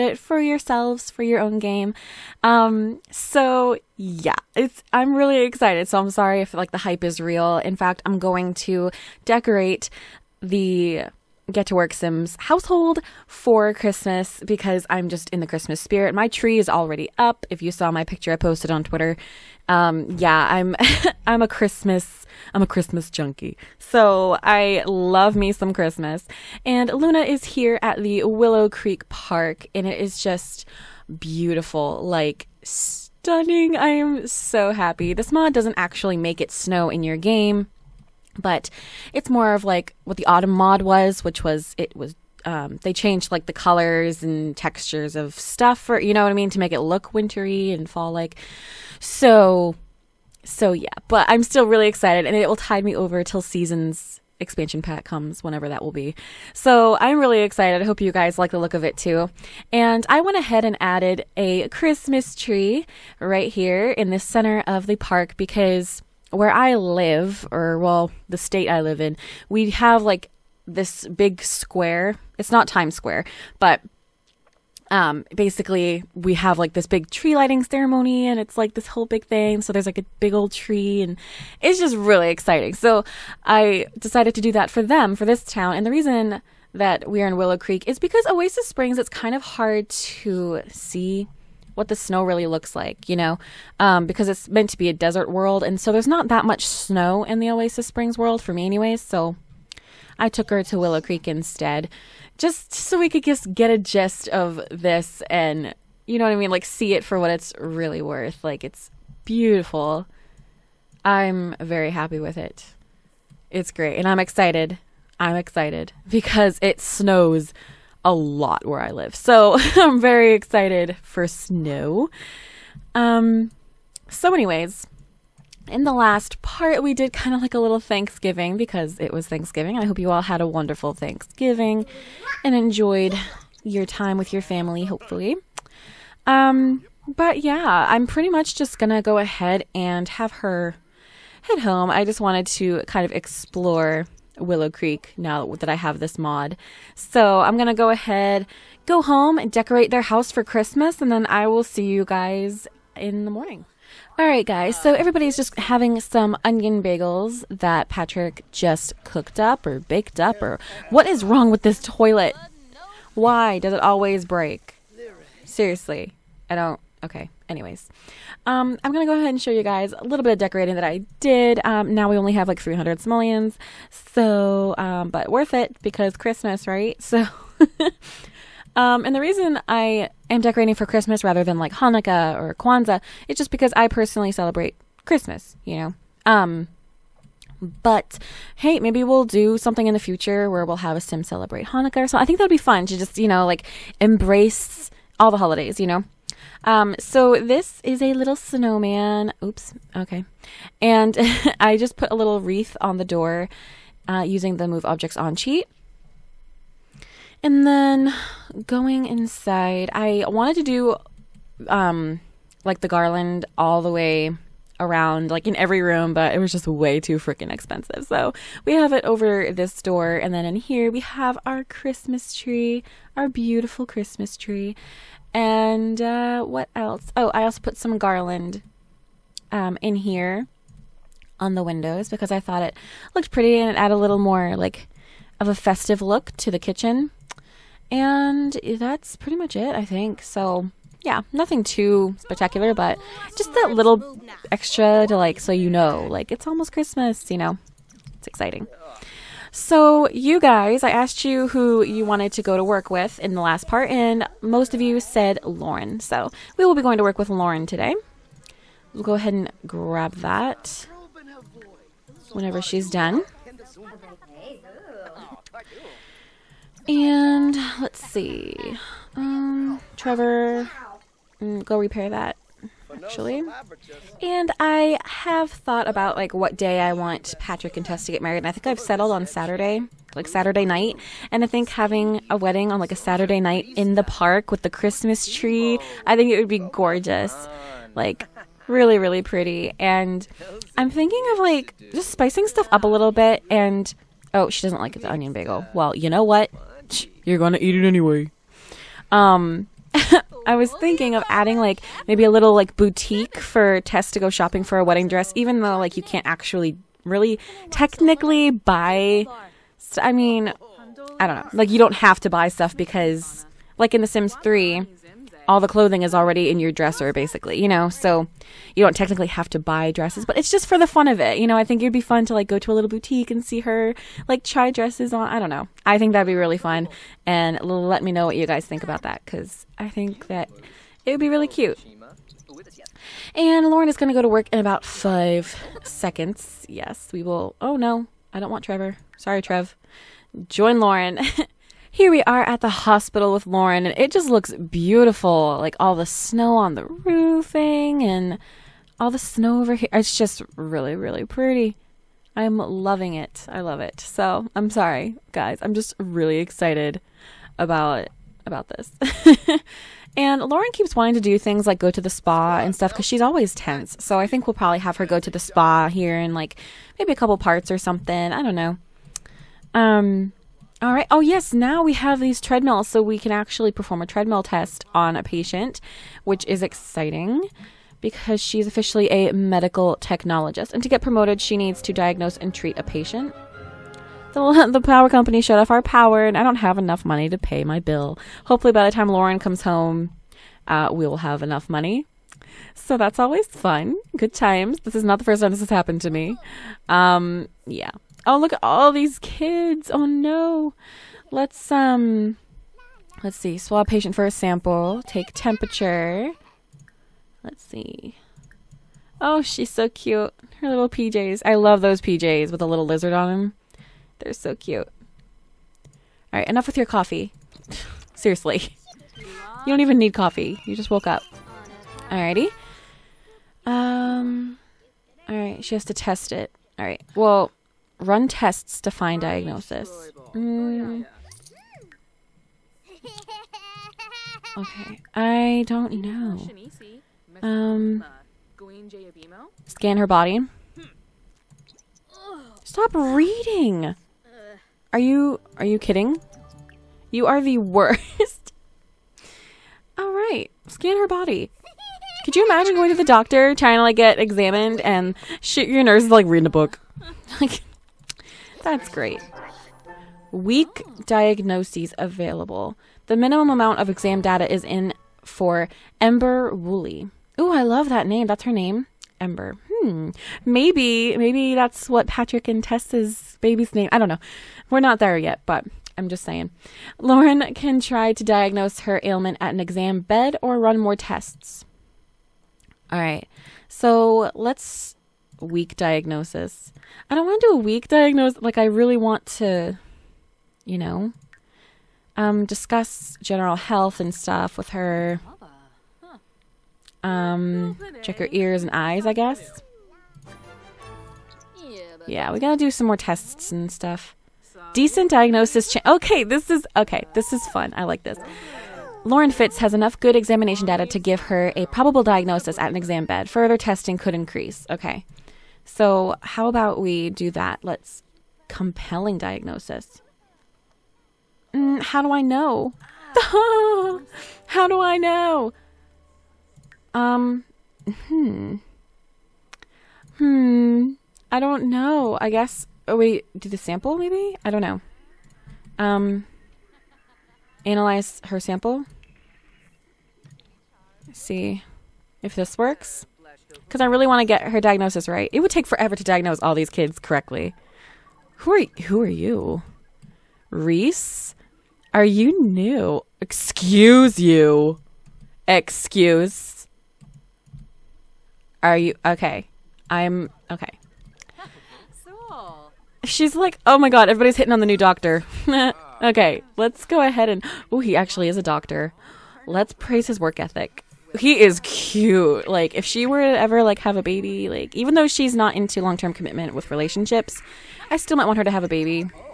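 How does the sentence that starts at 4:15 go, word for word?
So, we will be going to work with Lauren today.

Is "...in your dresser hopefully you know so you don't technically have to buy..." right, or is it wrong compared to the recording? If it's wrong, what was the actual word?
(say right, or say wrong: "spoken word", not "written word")
wrong: "basically", not "hopefully".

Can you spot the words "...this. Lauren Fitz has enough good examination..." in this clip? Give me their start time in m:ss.
8:28.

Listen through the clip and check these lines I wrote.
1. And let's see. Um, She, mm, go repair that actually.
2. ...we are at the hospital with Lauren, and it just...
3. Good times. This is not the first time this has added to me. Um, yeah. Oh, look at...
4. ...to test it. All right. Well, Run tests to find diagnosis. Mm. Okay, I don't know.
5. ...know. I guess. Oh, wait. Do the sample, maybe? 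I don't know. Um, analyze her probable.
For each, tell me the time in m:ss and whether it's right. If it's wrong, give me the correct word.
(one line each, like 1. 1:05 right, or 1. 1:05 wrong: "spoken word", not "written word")
1. 4:26 wrong: "Trevor", not "She"
2. 5:42 right
3. 6:34 wrong: "happened", not "added"
4. 7:05 right
5. 8:51 wrong: "sample", not "probable".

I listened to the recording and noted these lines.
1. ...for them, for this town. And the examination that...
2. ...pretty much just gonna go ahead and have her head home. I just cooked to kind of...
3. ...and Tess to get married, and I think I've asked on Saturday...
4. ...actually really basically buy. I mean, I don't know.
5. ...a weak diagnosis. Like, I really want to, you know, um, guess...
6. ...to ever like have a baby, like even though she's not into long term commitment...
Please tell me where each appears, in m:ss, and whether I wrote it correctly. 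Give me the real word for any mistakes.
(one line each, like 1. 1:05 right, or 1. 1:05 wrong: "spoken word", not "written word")
1. 1:24 wrong: "reason", not "examination"
2. 2:18 wrong: "wanted", not "cooked"
3. 4:37 wrong: "settled", not "asked"
4. 5:06 wrong: "technically", not "basically"
5. 8:07 wrong: "discuss", not "guess"
6. 9:33 right.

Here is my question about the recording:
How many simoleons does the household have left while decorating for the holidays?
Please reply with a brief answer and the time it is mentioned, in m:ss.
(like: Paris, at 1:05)
300, at 2:52.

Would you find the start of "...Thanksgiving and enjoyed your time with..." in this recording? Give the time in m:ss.
2:10.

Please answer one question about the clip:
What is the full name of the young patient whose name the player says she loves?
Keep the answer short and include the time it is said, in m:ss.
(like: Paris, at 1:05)
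Ember Woolley, at 7:45.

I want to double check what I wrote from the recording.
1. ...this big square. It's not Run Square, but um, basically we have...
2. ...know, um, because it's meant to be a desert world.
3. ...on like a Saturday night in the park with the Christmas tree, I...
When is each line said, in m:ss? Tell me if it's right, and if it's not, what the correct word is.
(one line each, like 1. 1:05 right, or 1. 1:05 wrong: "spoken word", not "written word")
1. 1:10 wrong: "Times", not "Run"
2. 1:33 right
3. 4:42 right.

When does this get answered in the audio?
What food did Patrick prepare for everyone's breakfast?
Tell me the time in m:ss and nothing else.
2:36.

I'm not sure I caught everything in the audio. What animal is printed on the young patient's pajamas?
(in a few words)
Lizard.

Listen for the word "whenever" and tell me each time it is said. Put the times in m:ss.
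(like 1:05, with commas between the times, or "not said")
0:55, 4:22.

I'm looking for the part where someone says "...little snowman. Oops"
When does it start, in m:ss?
3:18.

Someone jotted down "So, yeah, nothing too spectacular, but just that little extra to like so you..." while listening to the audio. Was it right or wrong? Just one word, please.
right.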